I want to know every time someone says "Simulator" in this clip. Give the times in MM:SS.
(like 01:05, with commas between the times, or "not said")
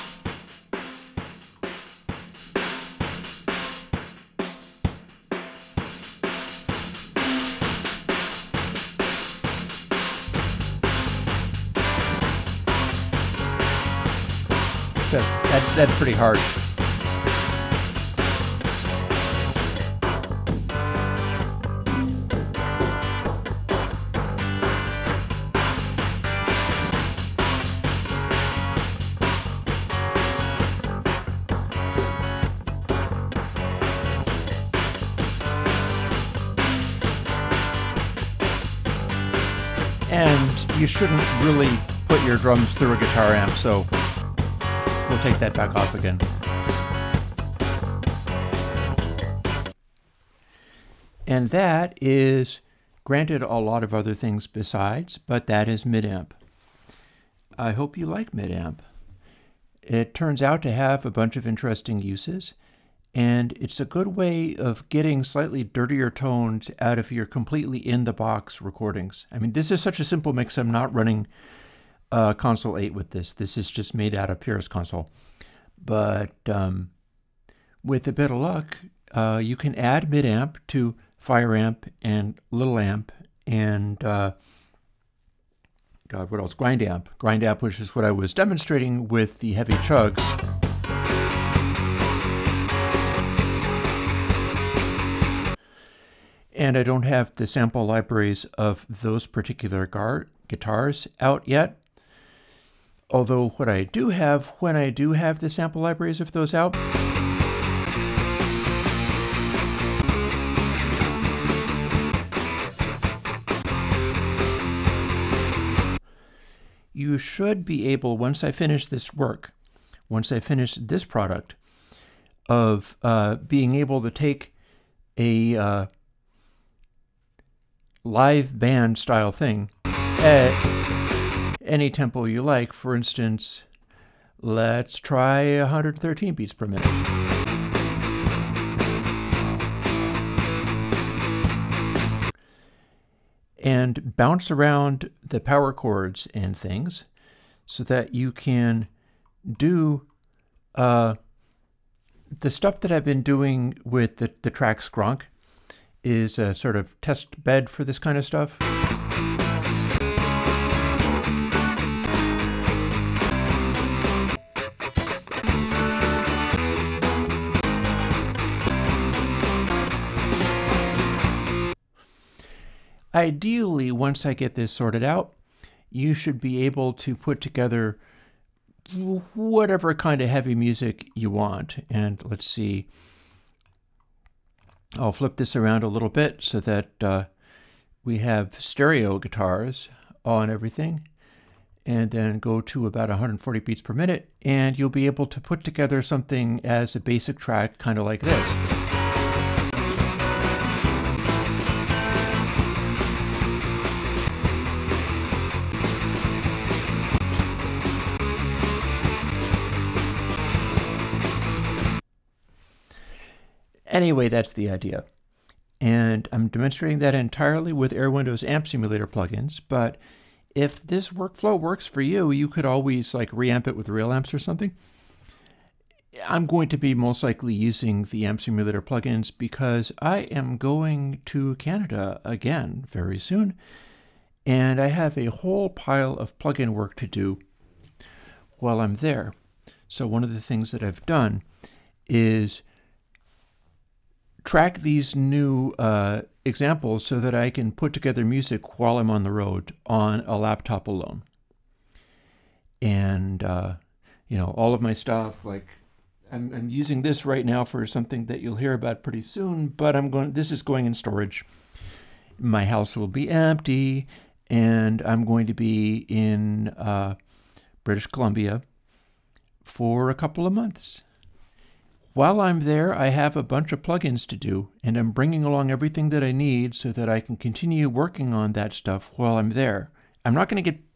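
03:38, 03:48.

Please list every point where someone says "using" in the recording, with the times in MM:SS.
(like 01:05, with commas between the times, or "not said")
03:47, 04:16.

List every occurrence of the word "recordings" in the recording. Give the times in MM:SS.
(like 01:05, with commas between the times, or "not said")
01:08.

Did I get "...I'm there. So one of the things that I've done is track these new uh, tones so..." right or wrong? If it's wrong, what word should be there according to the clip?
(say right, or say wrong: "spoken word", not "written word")
wrong: "examples", not "tones".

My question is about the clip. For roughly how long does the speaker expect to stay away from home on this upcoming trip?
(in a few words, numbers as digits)
A couple of months.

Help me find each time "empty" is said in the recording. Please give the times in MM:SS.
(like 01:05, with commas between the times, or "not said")
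04:23.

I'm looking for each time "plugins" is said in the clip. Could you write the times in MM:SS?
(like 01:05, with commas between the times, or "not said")
03:39, 03:48, 03:56, 04:33.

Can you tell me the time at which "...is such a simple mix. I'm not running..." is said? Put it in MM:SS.
01:09.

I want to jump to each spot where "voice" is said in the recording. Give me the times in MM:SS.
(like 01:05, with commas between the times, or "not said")
not said.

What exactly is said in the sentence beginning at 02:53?
Ideally, once I get this sorted out, you should be able to put together whatever kind of heavy music you want.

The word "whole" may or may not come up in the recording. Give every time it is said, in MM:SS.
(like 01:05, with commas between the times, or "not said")
03:55.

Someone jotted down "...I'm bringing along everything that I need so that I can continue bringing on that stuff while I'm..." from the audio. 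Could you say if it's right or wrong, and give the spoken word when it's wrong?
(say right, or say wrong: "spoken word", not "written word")
wrong: "working", not "bringing".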